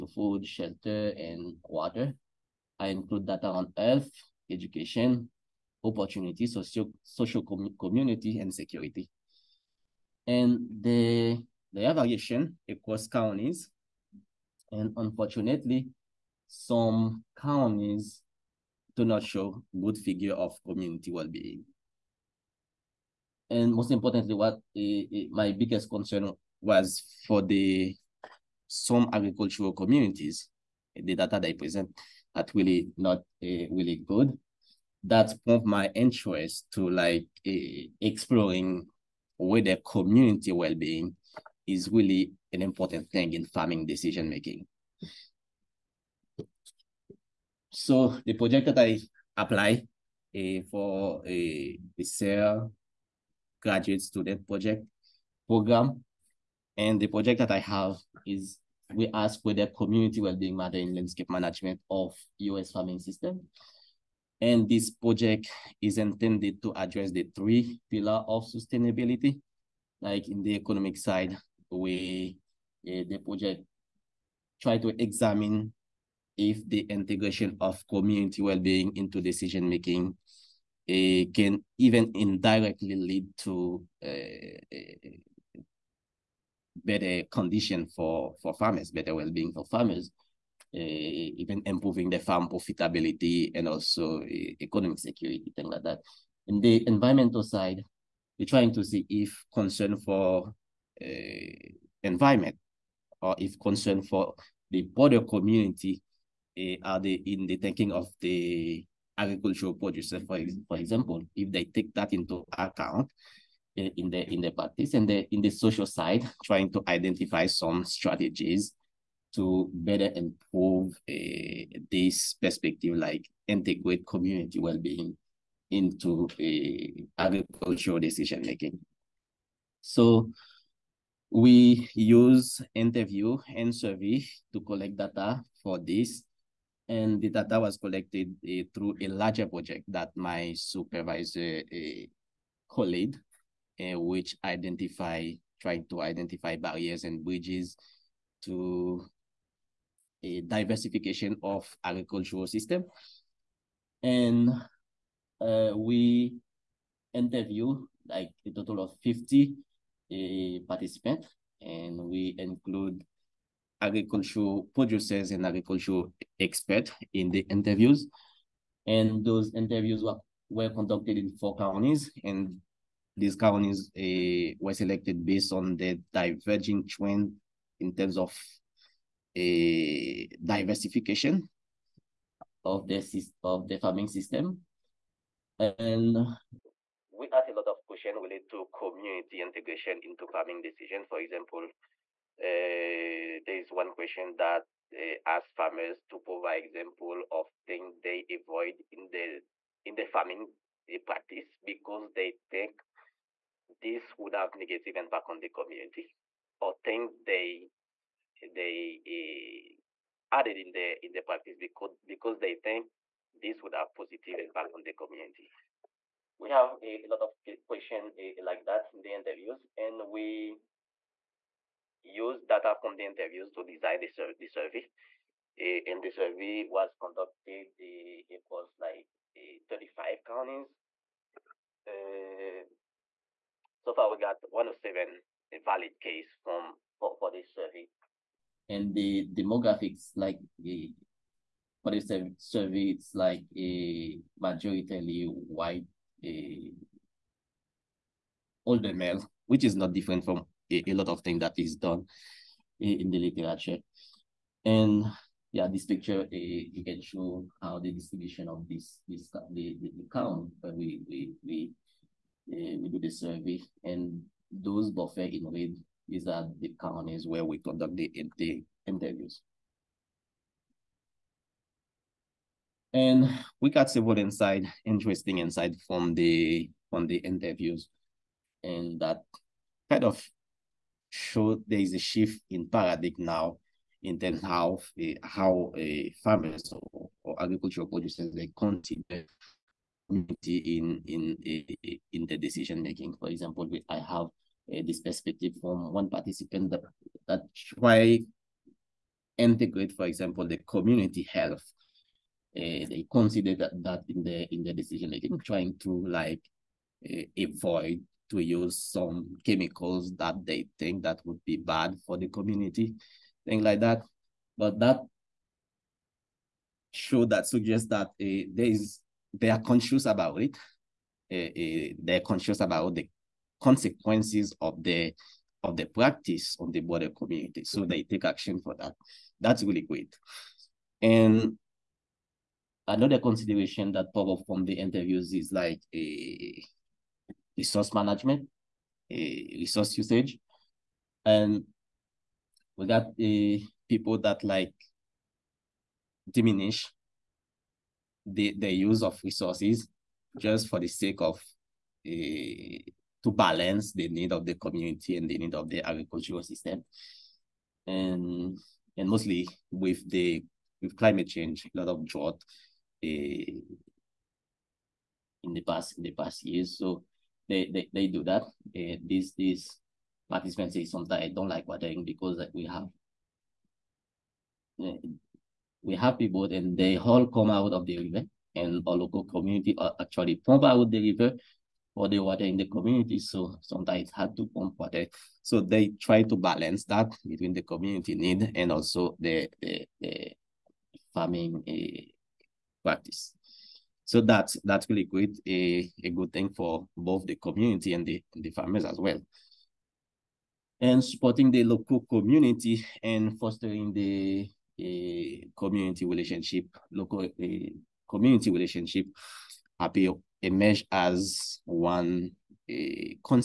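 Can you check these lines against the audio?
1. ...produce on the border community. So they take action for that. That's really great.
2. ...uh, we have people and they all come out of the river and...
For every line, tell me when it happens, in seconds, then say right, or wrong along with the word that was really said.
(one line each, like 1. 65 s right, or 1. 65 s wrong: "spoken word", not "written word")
1. 325 s wrong: "practice", not "produce"
2. 374 s right.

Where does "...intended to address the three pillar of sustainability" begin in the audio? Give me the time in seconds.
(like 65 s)
65 s.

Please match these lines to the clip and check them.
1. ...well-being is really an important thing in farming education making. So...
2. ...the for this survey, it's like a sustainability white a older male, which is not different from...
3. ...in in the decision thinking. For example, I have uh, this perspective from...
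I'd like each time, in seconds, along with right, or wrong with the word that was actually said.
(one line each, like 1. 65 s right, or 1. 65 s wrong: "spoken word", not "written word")
1. 40 s wrong: "decision", not "education"
2. 240 s wrong: "majority", not "sustainability"
3. 291 s wrong: "making", not "thinking".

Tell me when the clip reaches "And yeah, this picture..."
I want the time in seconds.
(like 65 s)
254 s.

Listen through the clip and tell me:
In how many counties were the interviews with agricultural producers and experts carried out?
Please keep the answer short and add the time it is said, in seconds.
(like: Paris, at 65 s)
4, at 171 s.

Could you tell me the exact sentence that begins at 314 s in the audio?
But that show that suggests that uh, there is they are conscious about it.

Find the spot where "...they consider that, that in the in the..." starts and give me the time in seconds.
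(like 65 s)
302 s.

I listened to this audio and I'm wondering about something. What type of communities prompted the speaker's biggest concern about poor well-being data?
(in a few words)
Agricultural communities.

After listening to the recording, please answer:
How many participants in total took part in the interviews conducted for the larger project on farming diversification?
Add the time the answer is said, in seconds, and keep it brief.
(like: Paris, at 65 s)
50, at 159 s.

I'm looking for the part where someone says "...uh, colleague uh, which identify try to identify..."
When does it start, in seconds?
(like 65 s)
141 s.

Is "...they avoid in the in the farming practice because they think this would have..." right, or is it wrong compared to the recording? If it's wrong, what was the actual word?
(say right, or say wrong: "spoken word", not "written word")
right.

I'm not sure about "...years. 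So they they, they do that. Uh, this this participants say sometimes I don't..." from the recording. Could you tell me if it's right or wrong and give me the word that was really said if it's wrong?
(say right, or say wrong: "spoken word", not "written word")
right.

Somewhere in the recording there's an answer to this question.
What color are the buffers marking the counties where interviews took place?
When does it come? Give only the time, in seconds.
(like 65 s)
265 s.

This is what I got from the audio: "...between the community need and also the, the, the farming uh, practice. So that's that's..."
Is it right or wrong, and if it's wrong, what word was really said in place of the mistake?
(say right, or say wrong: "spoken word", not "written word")
right.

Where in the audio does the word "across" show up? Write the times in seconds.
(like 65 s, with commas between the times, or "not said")
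12 s.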